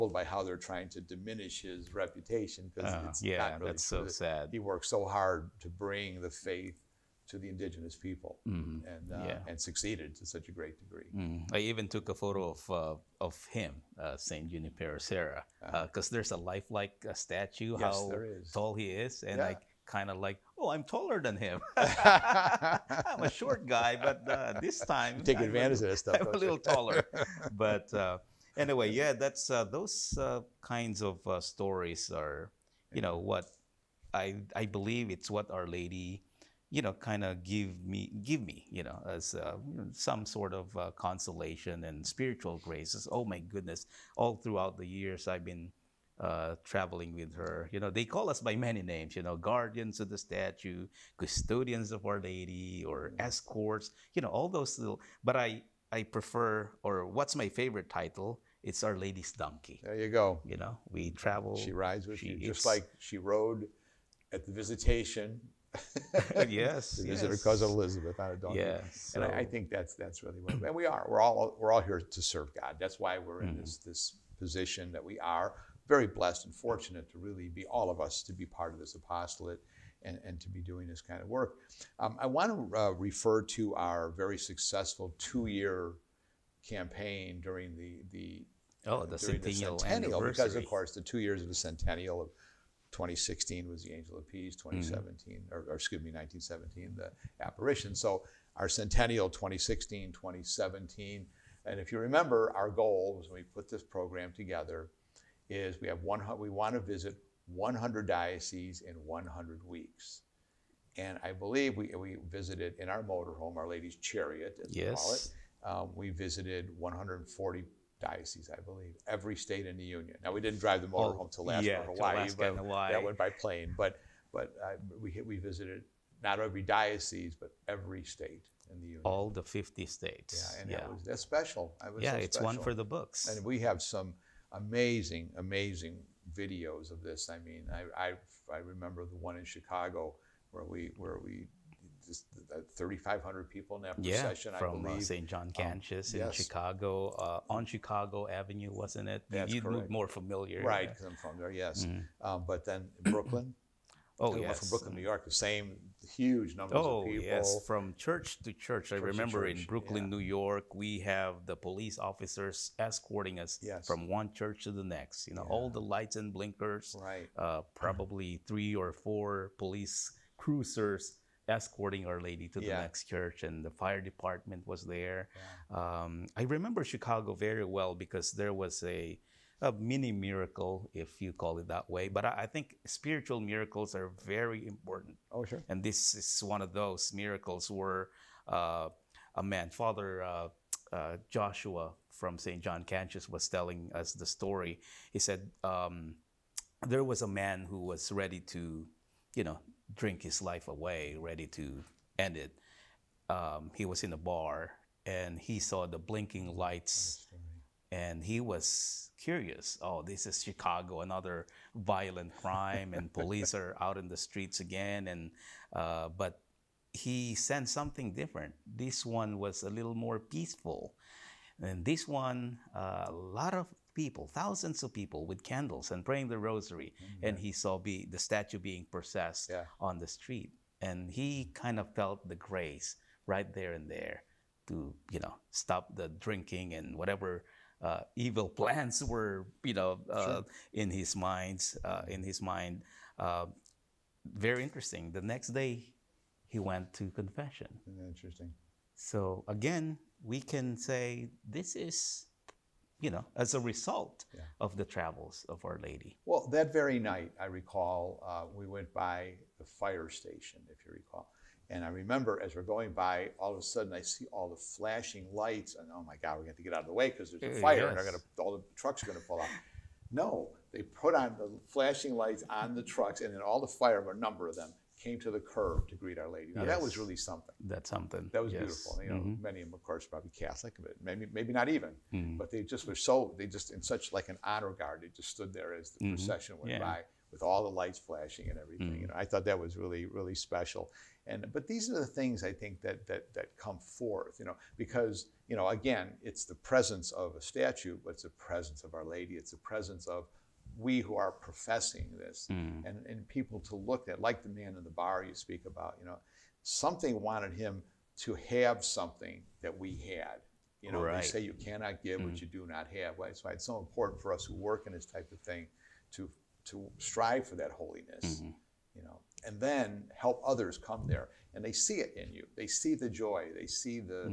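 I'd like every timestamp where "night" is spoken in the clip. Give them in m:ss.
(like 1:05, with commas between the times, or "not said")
4:16.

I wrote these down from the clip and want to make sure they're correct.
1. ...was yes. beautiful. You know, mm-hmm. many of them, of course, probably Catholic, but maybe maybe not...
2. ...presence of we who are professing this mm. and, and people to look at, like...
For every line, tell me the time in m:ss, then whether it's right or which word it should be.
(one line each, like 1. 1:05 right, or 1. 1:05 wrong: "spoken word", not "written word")
1. 4:38 right
2. 4:59 right.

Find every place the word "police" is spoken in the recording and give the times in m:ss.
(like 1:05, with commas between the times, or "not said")
2:41, 2:49, 3:33.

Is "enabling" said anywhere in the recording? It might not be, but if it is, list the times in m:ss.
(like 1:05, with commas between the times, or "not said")
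not said.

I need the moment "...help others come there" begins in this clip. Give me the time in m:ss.
5:20.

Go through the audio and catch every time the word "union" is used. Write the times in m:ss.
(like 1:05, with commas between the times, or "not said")
1:59, 2:08.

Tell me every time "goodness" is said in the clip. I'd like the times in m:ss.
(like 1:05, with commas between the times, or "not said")
0:43.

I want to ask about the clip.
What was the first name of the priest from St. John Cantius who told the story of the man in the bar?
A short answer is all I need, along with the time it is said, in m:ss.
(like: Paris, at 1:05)
Joshua, at 3:11.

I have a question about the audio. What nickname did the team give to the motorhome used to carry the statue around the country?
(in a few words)
Our Lady's Chariot.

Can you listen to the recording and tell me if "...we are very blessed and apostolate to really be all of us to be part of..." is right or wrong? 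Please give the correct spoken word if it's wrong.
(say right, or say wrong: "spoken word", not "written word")
wrong: "fortunate", not "apostolate".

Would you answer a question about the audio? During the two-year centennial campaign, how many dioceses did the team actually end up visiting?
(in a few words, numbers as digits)
140.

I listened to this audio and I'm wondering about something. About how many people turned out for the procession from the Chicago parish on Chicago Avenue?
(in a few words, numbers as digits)
3,500.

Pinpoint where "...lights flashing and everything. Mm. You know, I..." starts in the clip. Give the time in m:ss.
4:47.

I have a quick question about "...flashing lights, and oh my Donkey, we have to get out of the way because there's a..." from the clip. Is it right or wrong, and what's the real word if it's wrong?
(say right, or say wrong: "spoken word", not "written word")
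wrong: "God", not "Donkey".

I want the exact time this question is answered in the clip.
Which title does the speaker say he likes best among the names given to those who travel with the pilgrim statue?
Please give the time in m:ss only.
0:58.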